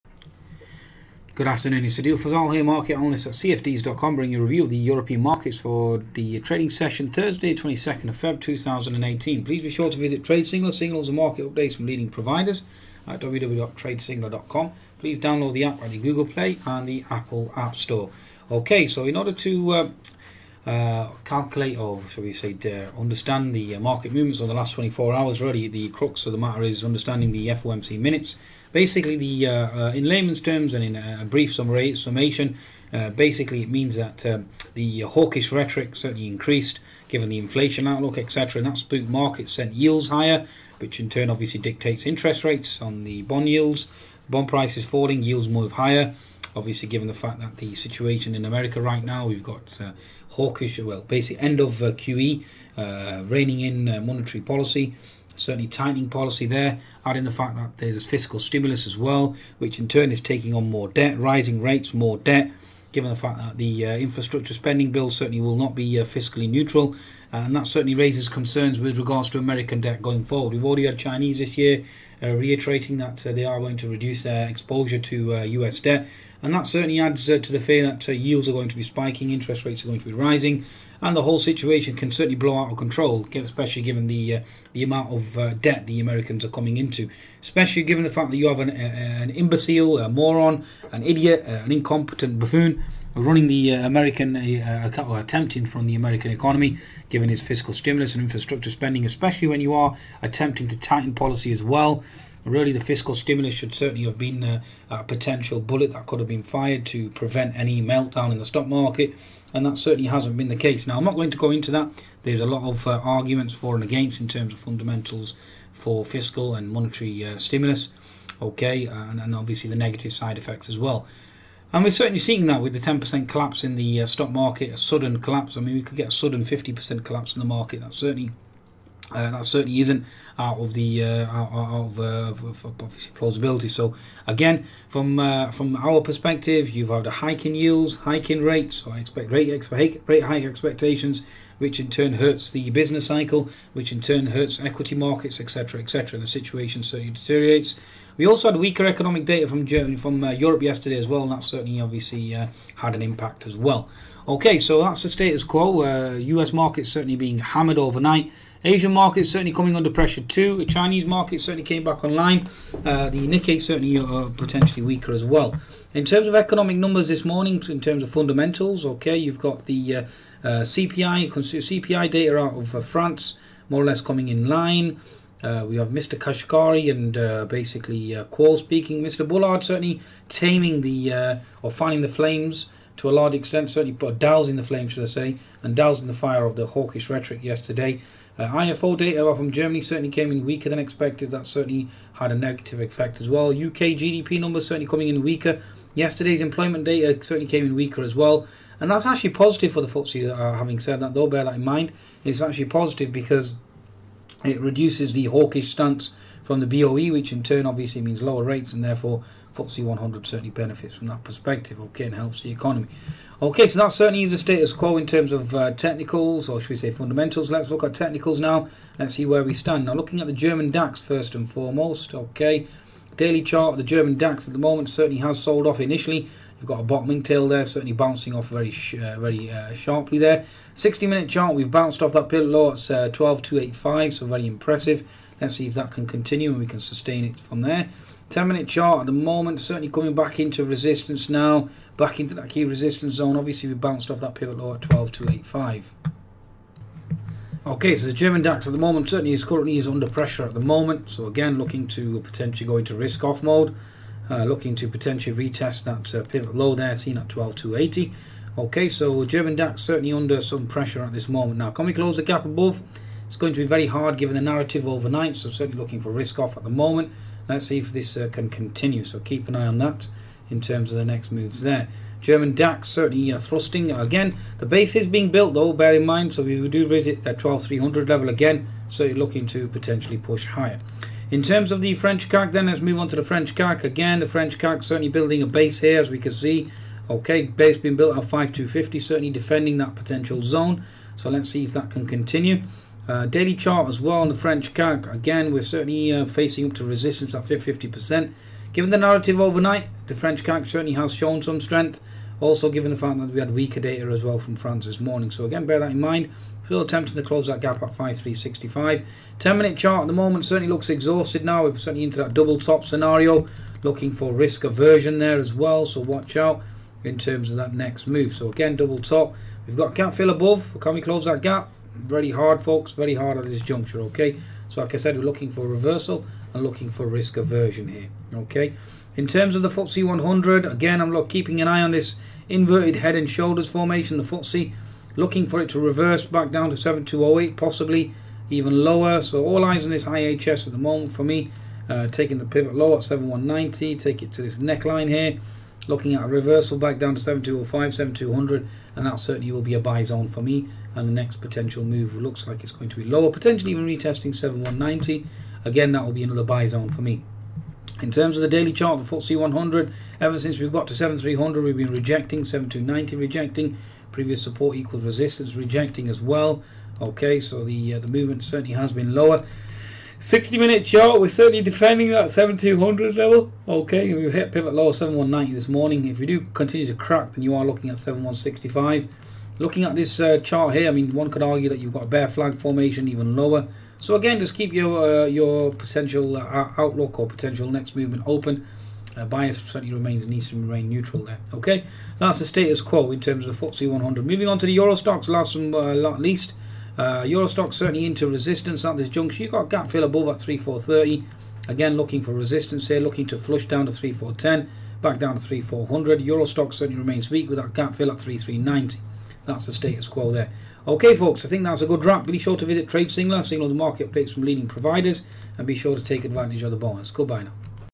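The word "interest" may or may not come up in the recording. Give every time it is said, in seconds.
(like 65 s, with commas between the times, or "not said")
42 s, 79 s.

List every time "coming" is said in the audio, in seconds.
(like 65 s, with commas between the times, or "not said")
86 s, 159 s, 173 s, 194 s, 239 s.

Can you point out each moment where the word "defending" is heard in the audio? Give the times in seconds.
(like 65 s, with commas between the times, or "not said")
289 s, 371 s.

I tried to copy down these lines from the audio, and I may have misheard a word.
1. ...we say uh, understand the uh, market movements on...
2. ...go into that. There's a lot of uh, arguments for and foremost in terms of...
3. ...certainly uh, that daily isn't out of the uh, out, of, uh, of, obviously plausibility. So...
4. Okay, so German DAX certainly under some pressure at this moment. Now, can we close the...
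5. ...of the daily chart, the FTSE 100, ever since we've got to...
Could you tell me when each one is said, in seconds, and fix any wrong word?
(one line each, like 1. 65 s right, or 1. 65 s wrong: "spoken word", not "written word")
1. 22 s right
2. 111 s wrong: "against", not "foremost"
3. 127 s wrong: "certainly", not "daily"
4. 258 s right
5. 358 s right.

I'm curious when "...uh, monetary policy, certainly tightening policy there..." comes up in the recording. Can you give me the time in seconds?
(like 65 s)
53 s.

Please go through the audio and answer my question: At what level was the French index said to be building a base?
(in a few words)
5250.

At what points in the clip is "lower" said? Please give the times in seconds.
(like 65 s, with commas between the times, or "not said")
208 s, 338 s, 353 s, 369 s, 383 s.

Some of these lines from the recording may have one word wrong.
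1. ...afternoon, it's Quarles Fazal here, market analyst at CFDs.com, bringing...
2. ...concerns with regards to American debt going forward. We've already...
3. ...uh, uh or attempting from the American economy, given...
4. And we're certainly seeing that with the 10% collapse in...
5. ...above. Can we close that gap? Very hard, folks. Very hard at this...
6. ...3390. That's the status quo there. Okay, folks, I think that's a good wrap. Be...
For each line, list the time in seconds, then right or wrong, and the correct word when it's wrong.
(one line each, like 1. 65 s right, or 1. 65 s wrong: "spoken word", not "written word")
1. 1 s wrong: "Adil", not "Quarles"
2. 68 s right
3. 94 s right
4. 121 s right
5. 320 s right
6. 408 s right.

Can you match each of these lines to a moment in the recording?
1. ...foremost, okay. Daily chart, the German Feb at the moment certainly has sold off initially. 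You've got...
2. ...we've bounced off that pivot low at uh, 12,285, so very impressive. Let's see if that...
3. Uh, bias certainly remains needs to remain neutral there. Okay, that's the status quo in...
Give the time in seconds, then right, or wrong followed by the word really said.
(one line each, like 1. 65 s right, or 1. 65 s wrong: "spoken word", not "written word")
1. 221 s wrong: "DAX", not "Feb"
2. 231 s right
3. 389 s right.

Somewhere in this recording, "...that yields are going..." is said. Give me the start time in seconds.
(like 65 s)
77 s.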